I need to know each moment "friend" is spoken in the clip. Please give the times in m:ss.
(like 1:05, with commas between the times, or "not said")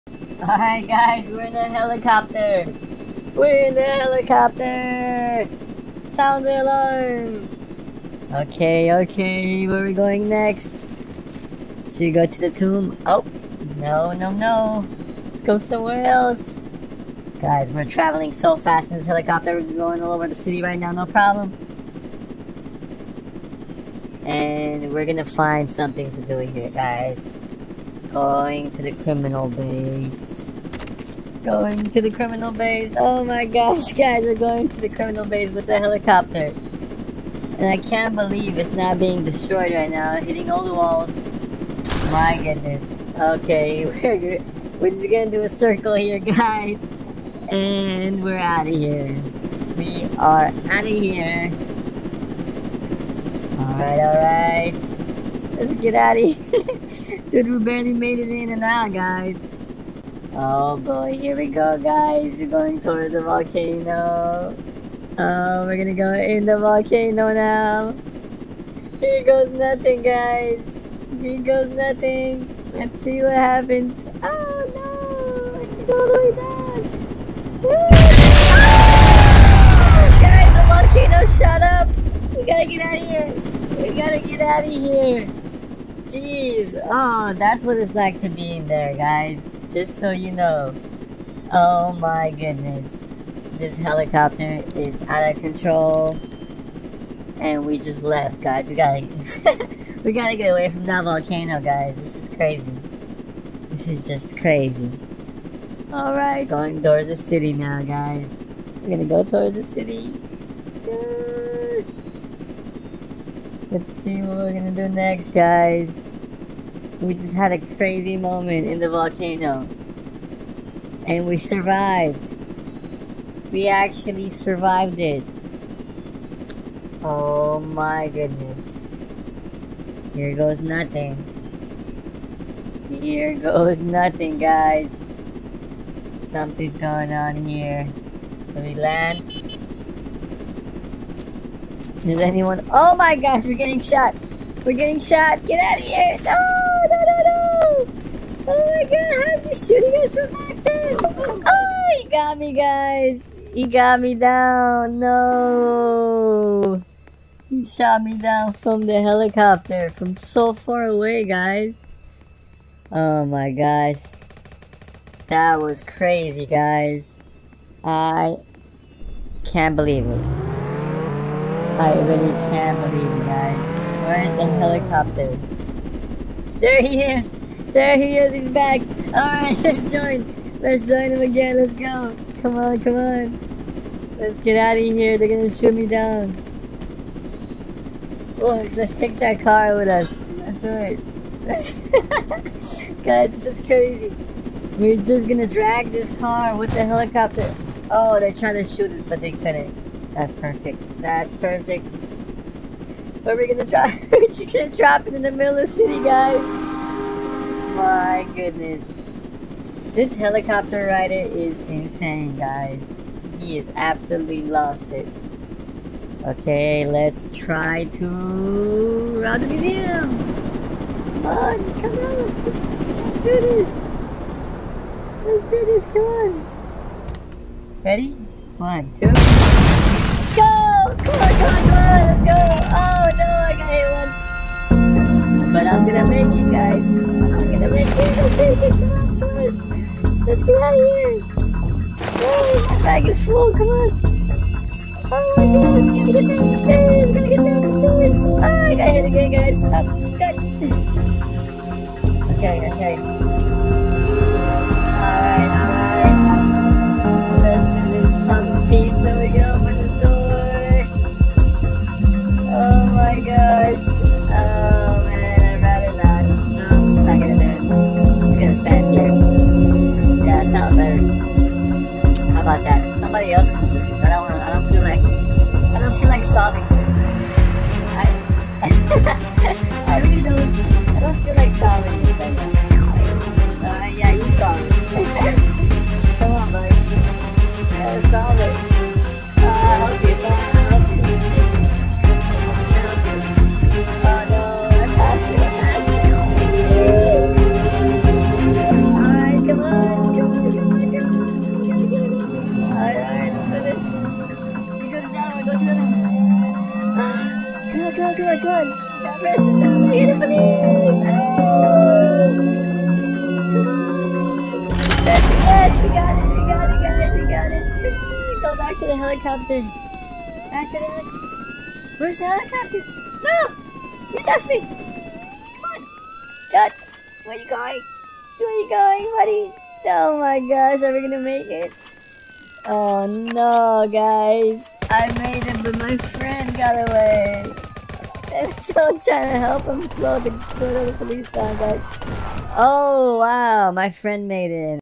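5:36, 5:43.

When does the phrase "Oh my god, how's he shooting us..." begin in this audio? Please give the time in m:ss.
2:28.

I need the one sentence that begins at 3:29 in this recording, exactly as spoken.
This helicopter rider is insane, guys.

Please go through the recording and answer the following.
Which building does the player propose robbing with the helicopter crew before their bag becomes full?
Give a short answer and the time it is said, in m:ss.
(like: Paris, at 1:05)
museum, at 3:39.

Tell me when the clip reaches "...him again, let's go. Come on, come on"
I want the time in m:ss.
3:01.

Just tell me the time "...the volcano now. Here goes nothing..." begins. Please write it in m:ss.
1:06.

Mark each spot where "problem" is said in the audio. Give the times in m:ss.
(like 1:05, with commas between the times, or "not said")
0:21.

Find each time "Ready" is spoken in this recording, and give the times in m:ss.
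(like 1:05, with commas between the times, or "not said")
3:47.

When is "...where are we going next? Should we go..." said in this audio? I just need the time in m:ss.
0:09.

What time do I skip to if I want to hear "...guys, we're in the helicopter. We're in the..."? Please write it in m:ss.
0:00.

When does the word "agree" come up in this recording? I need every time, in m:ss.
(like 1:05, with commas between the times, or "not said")
not said.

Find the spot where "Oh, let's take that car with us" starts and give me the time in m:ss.
3:08.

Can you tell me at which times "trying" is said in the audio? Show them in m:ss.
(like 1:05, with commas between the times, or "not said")
3:18, 5:38.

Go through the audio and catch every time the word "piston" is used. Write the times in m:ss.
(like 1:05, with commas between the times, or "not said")
not said.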